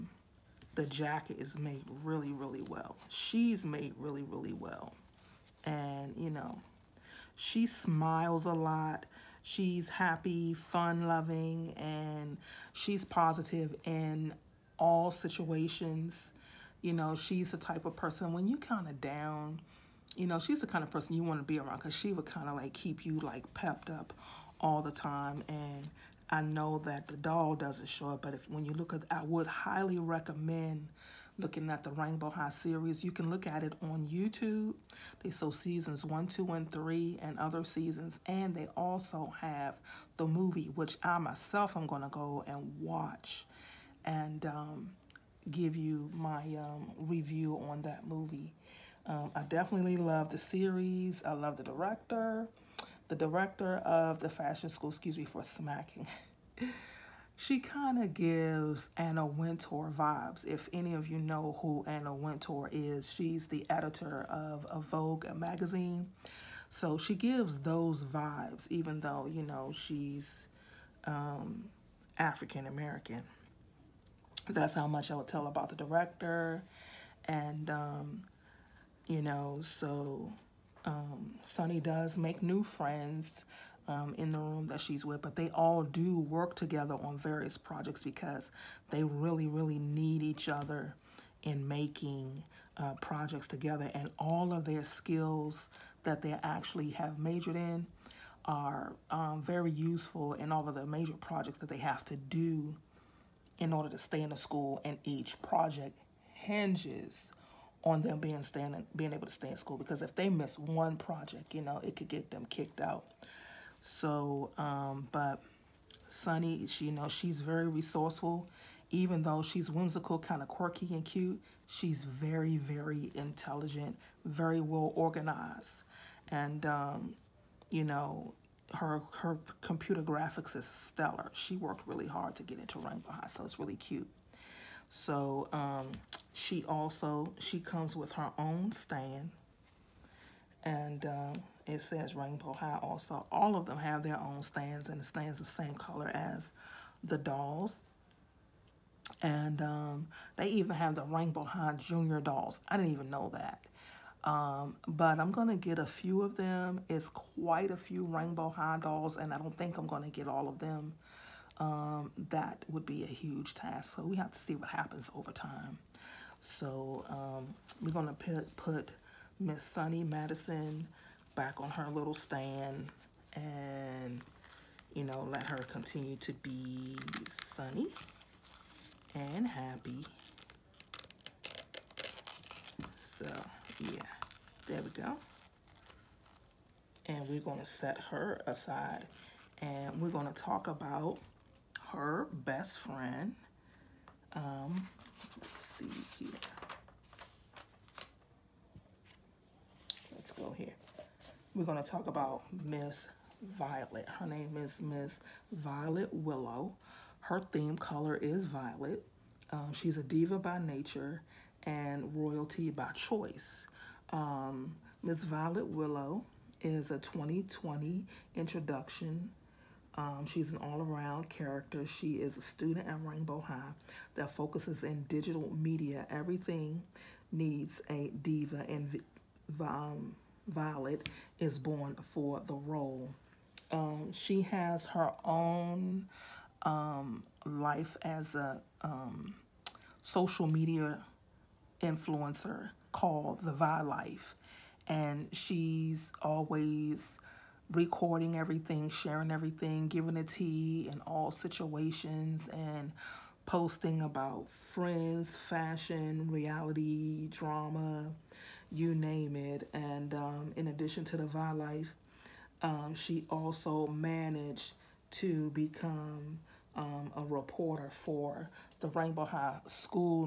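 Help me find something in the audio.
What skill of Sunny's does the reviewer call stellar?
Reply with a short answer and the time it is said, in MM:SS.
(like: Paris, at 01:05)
Computer graphics, at 02:09.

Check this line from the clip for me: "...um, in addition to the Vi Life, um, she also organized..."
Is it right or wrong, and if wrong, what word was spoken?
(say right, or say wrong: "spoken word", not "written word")
wrong: "managed", not "organized".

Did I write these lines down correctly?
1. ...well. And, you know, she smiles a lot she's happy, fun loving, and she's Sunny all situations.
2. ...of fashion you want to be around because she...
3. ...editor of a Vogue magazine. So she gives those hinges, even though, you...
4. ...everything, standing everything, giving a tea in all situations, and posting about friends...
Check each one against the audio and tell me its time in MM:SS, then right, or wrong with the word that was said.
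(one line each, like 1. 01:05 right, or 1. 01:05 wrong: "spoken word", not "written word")
1. 00:04 wrong: "And", not "Sunny"
2. 00:20 wrong: "person", not "fashion"
3. 01:03 wrong: "vibes", not "hinges"
4. 04:08 wrong: "sharing", not "standing".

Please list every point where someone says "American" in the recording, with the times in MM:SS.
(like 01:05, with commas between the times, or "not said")
01:12.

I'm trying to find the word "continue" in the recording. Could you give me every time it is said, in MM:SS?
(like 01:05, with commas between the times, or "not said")
02:55.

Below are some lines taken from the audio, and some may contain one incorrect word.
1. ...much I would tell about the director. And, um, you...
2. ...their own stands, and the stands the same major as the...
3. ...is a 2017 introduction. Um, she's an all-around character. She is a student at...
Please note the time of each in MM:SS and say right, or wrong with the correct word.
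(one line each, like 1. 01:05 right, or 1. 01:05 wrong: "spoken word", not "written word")
1. 01:14 right
2. 02:24 wrong: "color", not "major"
3. 03:36 wrong: "2020", not "2017".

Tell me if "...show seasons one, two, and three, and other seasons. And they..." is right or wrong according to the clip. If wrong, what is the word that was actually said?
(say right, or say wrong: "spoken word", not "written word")
right.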